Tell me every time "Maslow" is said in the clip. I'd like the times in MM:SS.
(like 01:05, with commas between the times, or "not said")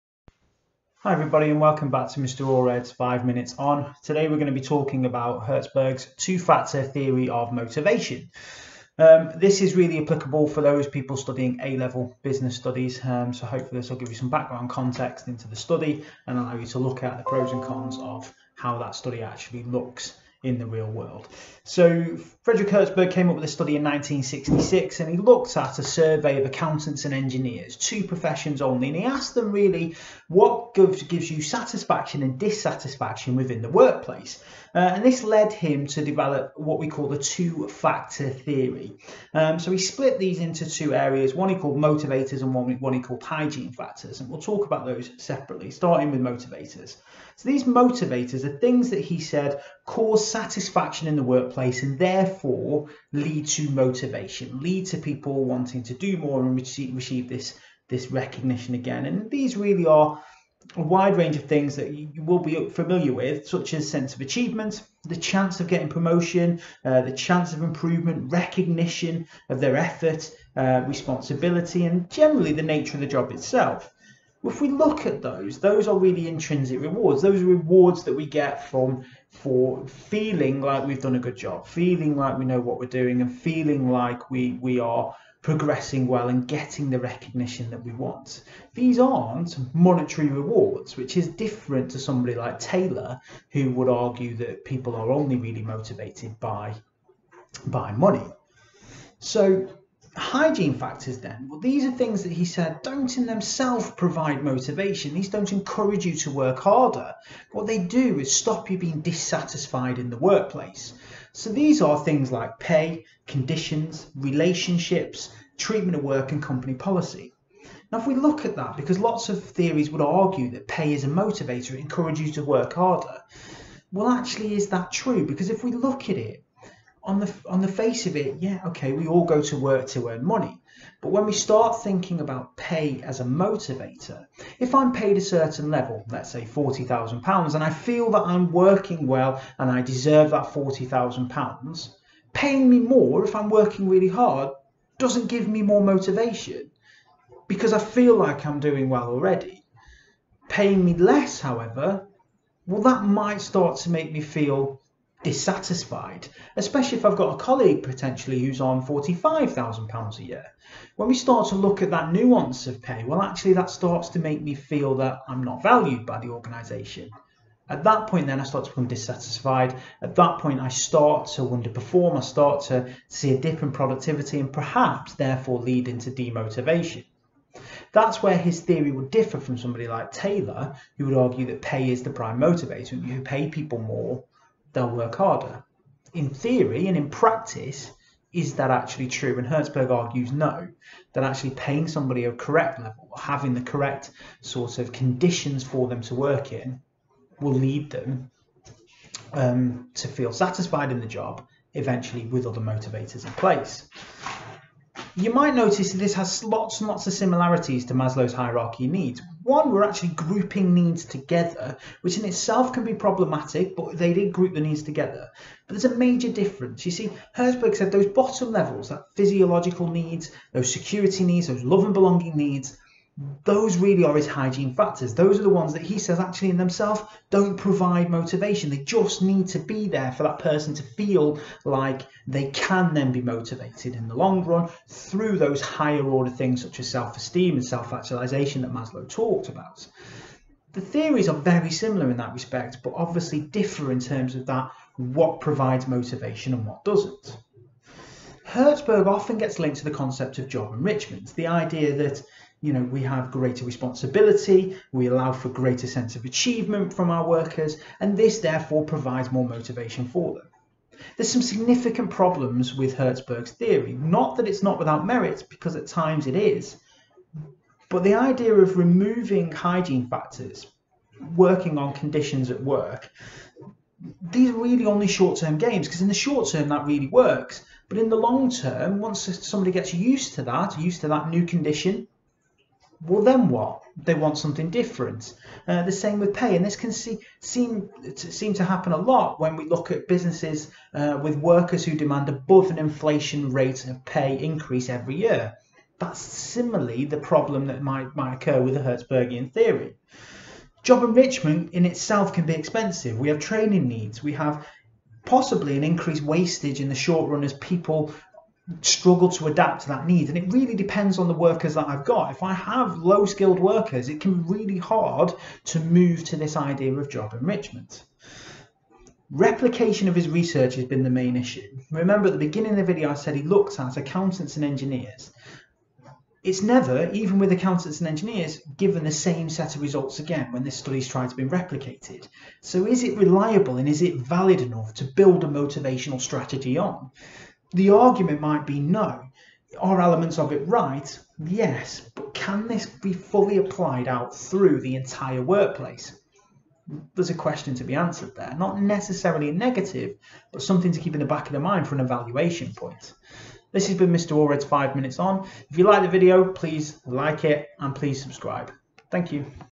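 03:27, 03:58.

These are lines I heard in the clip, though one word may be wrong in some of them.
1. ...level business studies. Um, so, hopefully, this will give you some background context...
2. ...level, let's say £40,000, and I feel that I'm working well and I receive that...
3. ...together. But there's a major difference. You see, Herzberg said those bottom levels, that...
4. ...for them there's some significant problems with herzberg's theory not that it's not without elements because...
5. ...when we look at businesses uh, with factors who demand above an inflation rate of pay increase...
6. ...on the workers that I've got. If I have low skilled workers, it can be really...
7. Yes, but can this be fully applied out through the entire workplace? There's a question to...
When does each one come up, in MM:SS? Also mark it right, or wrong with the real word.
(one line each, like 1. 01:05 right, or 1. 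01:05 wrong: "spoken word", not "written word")
1. 00:11 right
2. 02:15 wrong: "deserve", not "receive"
3. 03:34 right
4. 04:20 wrong: "merits", not "elements"
5. 04:49 wrong: "workers", not "factors"
6. 05:11 right
7. 05:41 right.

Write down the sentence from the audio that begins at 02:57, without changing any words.
That's where his theory would differ from somebody like Taylor, who would argue that pay is the prime motivator.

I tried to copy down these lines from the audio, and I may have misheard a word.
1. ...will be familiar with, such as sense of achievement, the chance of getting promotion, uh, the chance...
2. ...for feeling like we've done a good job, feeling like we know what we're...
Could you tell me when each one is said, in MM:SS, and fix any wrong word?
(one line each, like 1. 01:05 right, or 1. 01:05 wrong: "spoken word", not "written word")
1. 01:02 right
2. 01:19 right.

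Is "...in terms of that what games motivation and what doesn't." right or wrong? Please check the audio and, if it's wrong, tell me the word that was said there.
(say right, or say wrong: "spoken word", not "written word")
wrong: "provides", not "games".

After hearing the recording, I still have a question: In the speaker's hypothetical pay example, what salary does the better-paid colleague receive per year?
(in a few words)
£45,000.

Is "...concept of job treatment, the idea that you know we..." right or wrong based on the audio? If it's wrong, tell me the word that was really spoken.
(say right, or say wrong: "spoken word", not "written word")
wrong: "enrichment", not "treatment".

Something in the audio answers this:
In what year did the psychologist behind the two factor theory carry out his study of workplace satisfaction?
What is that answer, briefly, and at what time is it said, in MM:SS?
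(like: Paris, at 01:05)
1966, at 00:23.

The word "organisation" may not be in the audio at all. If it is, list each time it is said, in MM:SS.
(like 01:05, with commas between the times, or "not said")
02:46.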